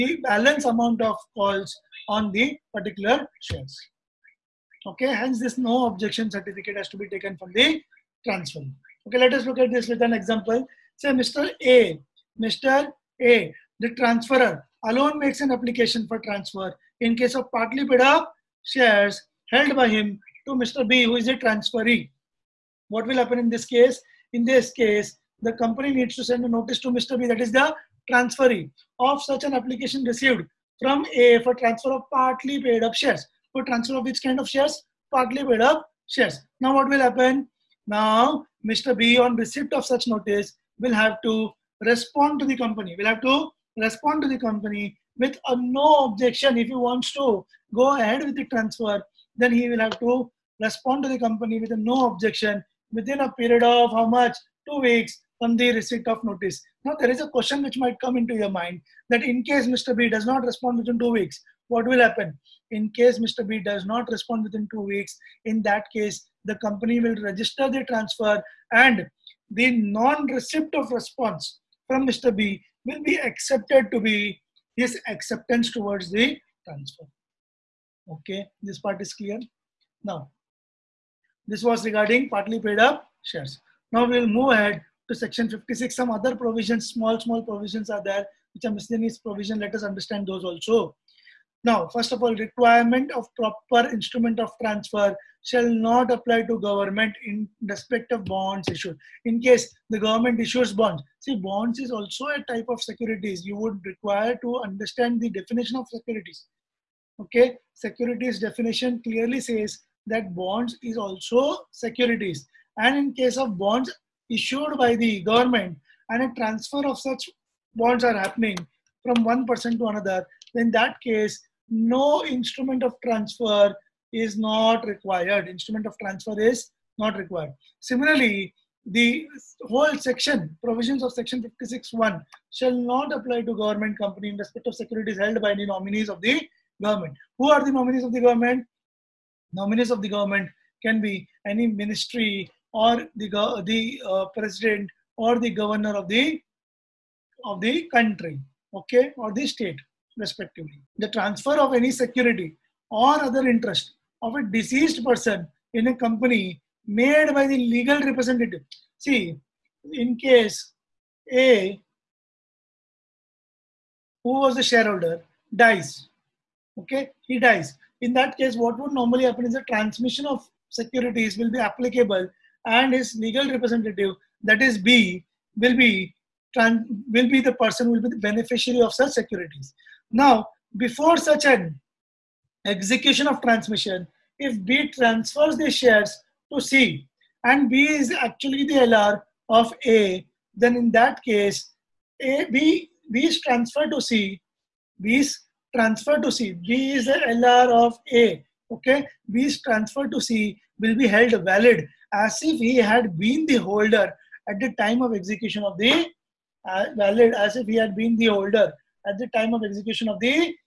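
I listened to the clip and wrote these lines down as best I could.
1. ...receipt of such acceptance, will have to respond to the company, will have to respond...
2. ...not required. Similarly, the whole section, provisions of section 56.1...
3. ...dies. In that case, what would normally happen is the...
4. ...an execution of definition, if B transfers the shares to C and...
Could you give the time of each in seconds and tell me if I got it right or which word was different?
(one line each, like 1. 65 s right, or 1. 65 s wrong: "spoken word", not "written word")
1. 39 s wrong: "notice", not "acceptance"
2. 126 s right
3. 167 s right
4. 181 s wrong: "transmission", not "definition".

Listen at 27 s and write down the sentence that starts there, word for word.
B, that is the transferee, of such an application received from A for transfer of partly paid up shares.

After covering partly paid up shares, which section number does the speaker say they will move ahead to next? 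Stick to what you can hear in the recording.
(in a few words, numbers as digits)
56.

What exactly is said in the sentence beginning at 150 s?
The transfer of any security or other interest of a deceased person in a company made by the legal representative.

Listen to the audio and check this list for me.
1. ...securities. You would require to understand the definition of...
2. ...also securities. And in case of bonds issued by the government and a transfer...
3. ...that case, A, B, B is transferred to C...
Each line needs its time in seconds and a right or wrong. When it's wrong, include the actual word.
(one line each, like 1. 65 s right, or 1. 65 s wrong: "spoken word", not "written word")
1. 102 s right
2. 110 s right
3. 190 s right.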